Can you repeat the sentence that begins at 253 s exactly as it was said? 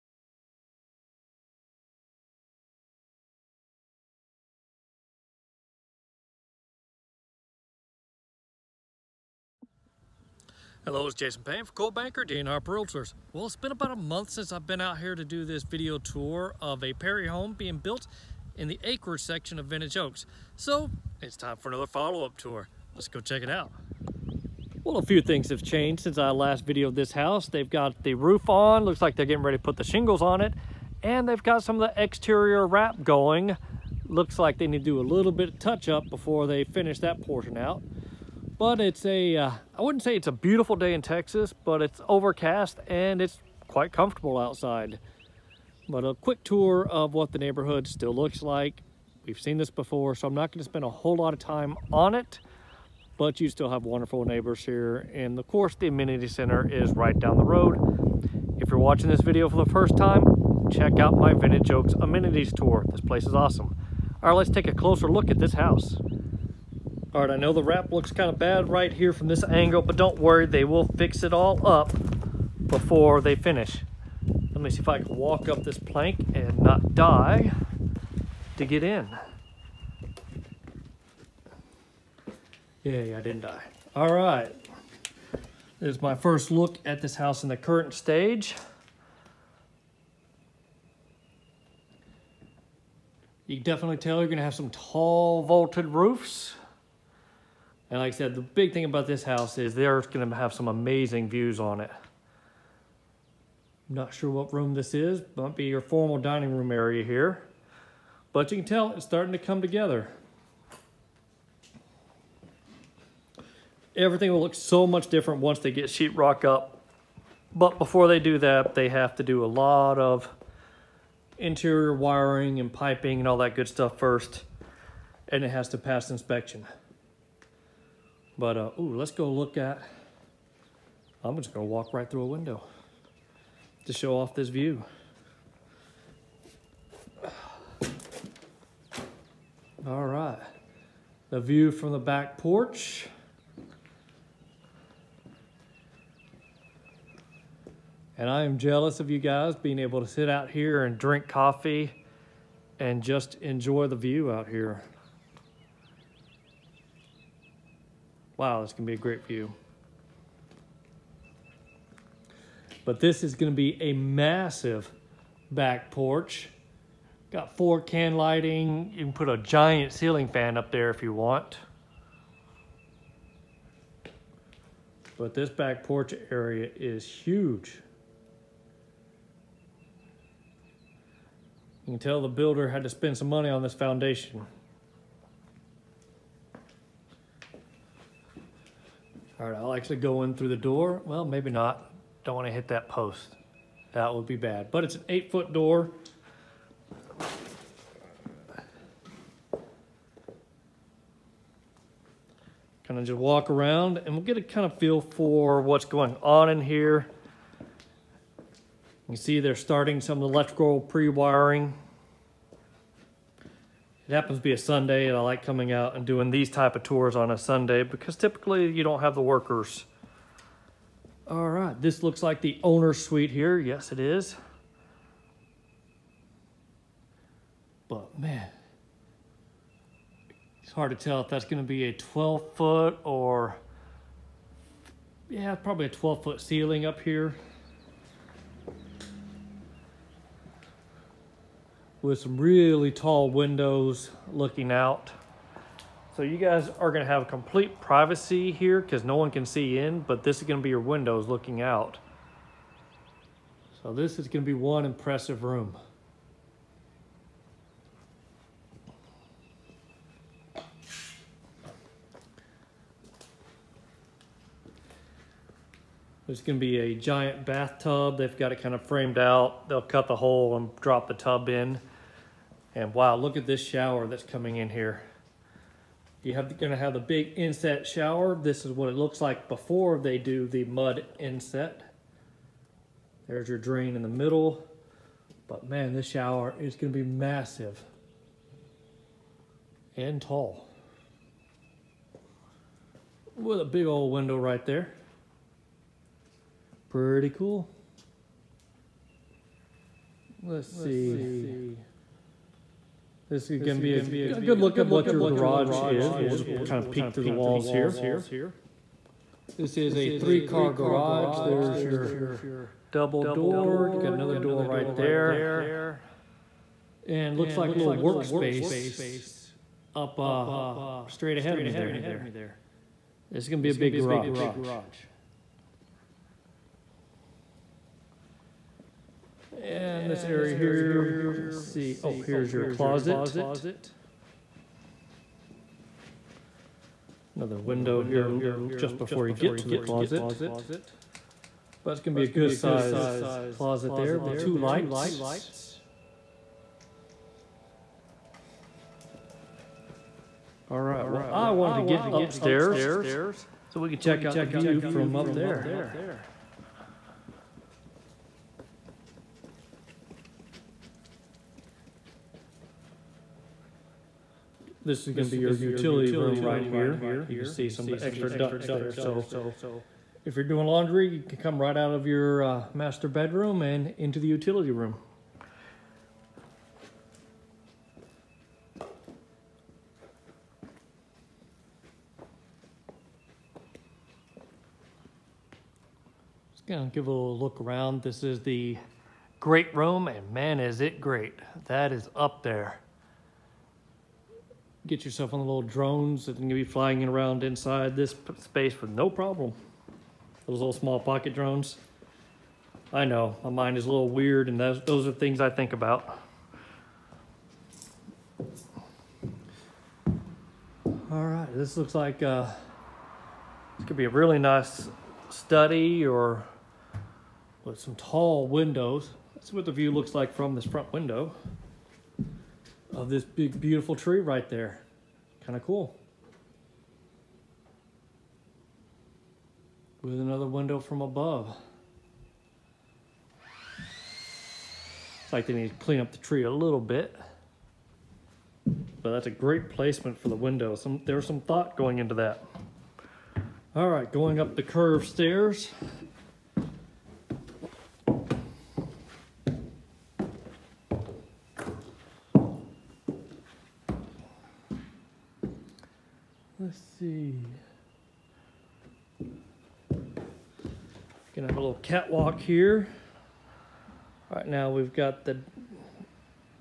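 So this is gonna be one impressive room.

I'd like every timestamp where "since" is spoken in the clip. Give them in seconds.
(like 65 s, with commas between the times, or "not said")
14 s, 26 s.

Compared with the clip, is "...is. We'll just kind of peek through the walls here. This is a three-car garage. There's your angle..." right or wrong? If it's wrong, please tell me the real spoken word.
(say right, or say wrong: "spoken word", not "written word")
wrong: "double", not "angle".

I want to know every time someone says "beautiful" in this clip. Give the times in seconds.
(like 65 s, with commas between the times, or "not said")
40 s, 423 s.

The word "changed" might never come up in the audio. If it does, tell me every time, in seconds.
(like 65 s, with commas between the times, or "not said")
25 s.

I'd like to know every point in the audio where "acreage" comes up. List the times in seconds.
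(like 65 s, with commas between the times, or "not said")
18 s.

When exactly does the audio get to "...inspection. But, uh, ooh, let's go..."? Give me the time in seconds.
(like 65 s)
126 s.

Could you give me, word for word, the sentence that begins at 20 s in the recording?
So, it's time for another follow-up tour.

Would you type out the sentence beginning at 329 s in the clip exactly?
And this area here, let's see.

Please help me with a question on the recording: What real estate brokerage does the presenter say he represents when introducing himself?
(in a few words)
Coldwell Banker.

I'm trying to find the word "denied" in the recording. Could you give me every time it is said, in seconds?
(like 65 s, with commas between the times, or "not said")
not said.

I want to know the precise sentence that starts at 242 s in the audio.
with some really tall windows looking out.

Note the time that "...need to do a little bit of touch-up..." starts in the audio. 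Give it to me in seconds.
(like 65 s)
34 s.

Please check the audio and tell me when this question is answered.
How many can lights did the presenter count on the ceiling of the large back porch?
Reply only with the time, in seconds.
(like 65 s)
167 s.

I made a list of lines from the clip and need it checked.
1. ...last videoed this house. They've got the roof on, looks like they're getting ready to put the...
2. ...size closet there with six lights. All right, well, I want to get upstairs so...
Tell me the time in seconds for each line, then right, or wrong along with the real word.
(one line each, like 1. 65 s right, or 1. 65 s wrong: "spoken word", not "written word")
1. 26 s right
2. 342 s wrong: "two", not "six".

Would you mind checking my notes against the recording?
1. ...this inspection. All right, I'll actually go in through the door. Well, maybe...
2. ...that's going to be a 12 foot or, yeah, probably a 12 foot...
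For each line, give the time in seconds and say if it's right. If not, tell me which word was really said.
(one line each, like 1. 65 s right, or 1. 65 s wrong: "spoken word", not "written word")
1. 183 s wrong: "foundation", not "inspection"
2. 231 s right.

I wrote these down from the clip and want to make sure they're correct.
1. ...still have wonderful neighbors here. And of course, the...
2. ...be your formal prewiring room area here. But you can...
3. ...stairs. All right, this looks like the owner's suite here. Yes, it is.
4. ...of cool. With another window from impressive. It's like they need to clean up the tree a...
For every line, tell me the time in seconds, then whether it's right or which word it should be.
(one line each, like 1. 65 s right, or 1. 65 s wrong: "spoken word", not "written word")
1. 53 s right
2. 105 s wrong: "dining", not "prewiring"
3. 219 s wrong: "workers", not "stairs"
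4. 425 s wrong: "above", not "impressive".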